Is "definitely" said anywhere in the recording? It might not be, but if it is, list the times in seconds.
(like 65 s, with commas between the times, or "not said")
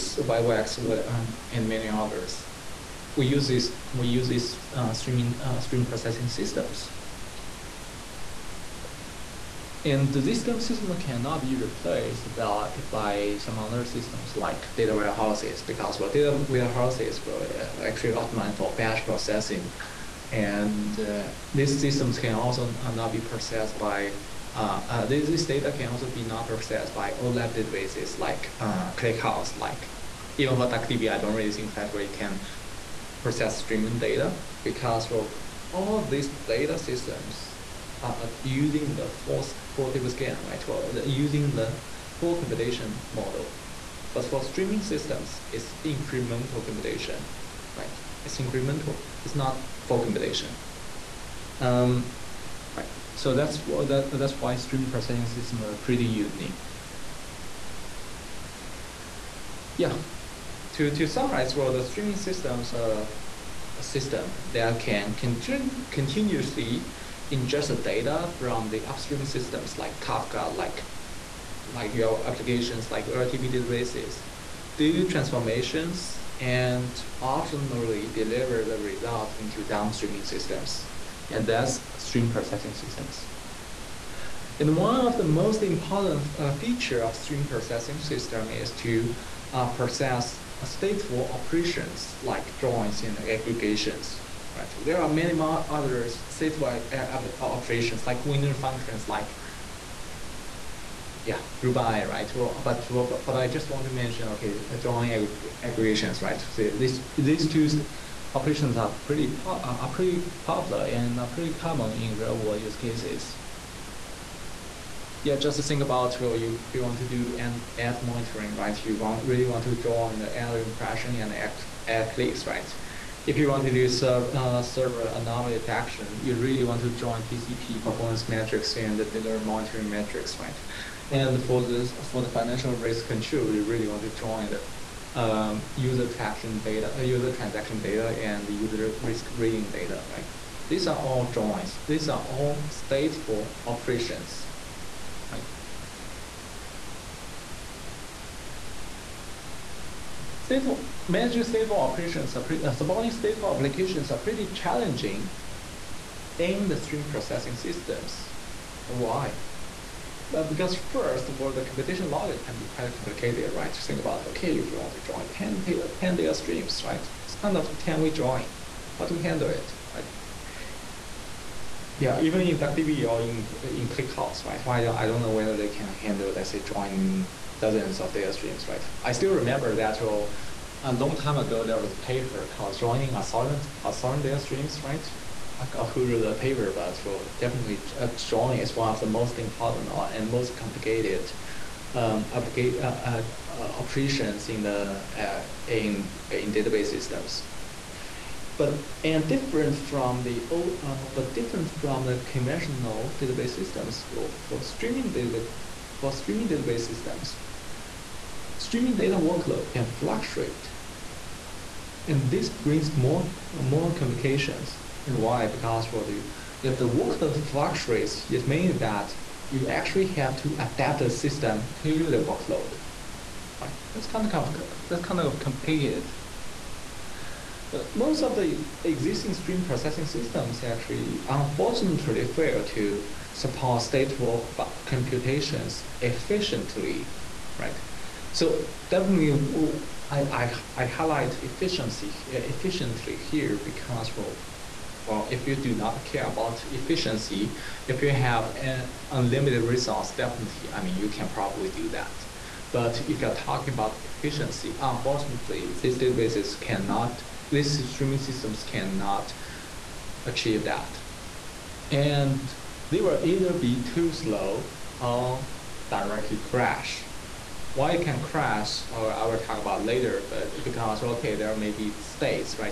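187 s, 238 s, 250 s.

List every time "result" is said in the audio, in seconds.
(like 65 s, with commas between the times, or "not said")
78 s.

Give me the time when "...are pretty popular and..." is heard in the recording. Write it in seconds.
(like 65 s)
109 s.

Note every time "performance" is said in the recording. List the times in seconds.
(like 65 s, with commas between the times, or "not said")
127 s.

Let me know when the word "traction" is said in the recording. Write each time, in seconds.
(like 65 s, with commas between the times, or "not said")
136 s.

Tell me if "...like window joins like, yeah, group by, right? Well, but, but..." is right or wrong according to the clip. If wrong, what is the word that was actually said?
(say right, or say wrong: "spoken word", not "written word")
wrong: "functions", not "joins".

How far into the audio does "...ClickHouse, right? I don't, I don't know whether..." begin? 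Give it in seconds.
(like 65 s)
173 s.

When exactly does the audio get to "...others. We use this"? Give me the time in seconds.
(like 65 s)
1 s.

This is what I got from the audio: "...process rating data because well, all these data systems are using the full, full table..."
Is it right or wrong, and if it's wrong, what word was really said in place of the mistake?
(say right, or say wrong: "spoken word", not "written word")
wrong: "streaming", not "rating".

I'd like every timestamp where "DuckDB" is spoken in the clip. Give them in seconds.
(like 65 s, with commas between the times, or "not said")
30 s, 172 s.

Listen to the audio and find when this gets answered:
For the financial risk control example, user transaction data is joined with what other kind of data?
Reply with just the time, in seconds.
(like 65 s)
138 s.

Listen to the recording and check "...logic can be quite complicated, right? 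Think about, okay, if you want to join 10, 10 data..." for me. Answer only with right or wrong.
right.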